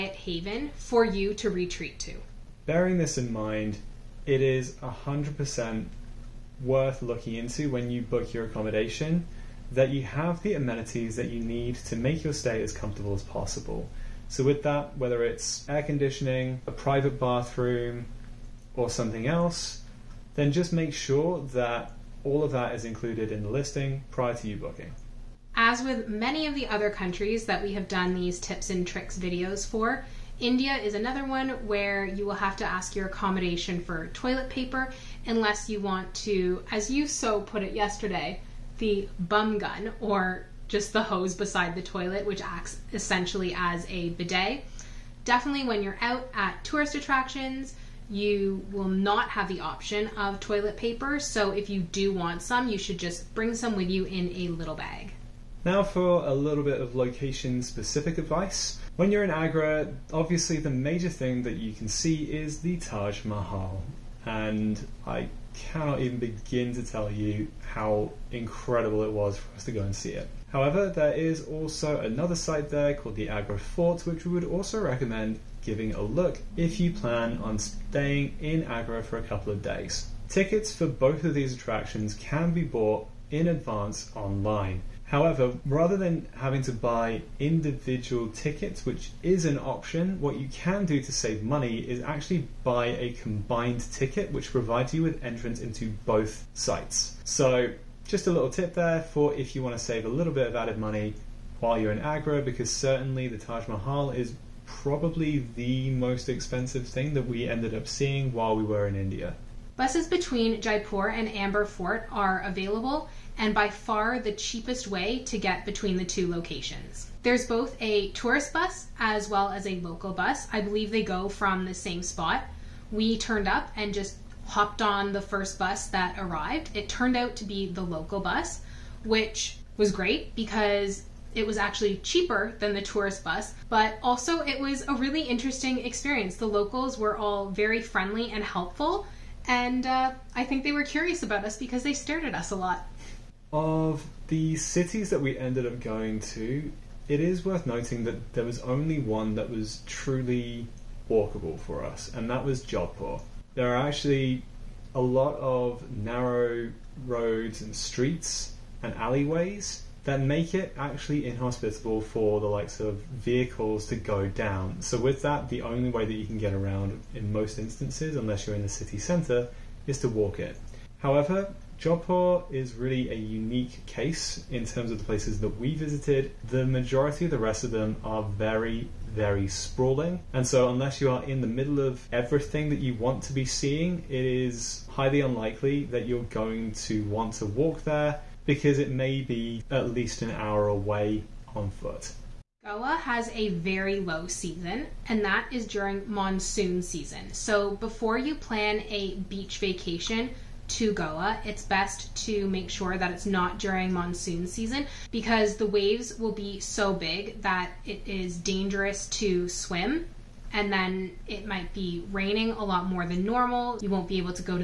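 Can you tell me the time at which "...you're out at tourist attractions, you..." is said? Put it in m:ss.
0:45.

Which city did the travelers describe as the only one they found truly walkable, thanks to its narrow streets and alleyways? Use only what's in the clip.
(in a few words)
Jodhpur.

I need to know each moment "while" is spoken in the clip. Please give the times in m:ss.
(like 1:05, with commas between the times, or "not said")
1:41, 1:48.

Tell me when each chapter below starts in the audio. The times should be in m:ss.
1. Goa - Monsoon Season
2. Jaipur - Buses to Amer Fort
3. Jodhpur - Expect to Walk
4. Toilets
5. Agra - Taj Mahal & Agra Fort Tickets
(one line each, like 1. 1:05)
1. 3:12
2. 1:49
3. 2:23
4. 0:25
5. 0:58.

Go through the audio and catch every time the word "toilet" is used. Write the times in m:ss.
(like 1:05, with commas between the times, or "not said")
0:34, 0:41, 0:50.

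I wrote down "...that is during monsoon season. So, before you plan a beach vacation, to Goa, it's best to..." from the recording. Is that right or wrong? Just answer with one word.
right.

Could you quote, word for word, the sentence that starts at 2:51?
However, Jaipur is really a unique case in terms of the places that we visited.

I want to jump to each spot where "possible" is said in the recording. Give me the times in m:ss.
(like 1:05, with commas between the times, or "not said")
0:13.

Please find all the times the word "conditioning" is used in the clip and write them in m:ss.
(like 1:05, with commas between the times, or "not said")
0:15.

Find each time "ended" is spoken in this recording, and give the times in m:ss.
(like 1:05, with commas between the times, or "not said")
1:47, 2:25.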